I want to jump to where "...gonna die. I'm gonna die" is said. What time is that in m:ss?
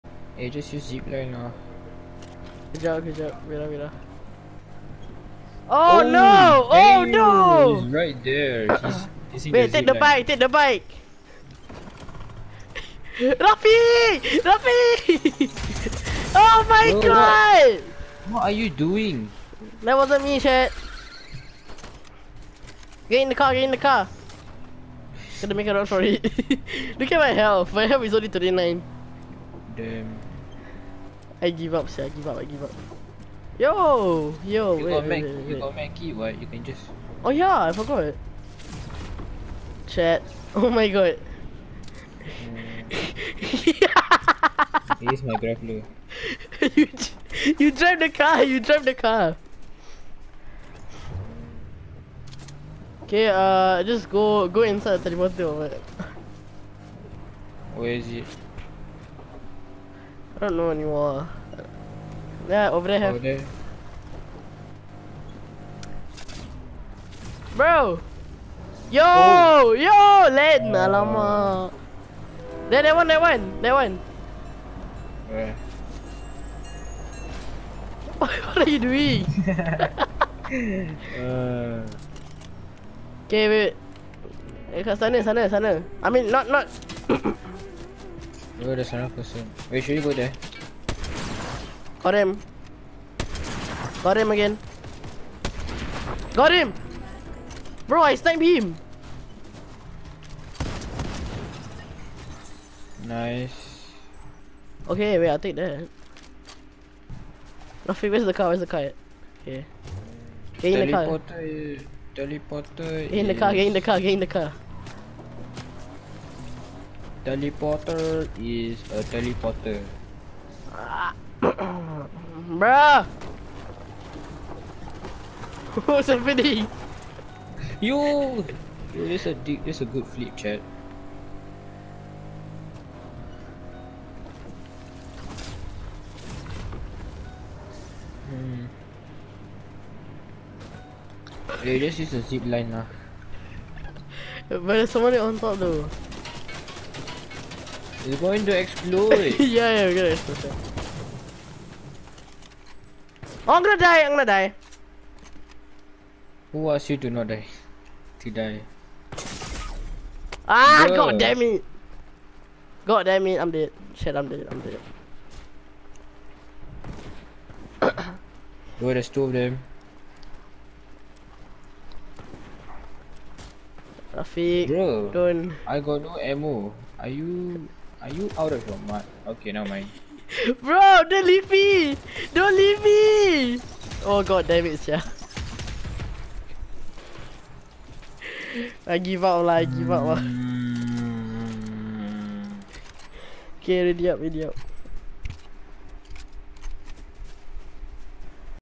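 2:33.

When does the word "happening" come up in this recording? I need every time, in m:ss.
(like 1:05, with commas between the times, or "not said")
2:06.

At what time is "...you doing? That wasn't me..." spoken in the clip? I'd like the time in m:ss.
0:18.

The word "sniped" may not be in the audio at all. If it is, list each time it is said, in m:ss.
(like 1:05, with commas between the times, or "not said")
1:38.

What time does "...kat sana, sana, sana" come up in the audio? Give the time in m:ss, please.
1:24.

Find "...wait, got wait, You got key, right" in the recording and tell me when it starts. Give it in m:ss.
0:34.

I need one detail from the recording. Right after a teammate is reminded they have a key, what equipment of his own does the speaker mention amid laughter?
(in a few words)
Grappler.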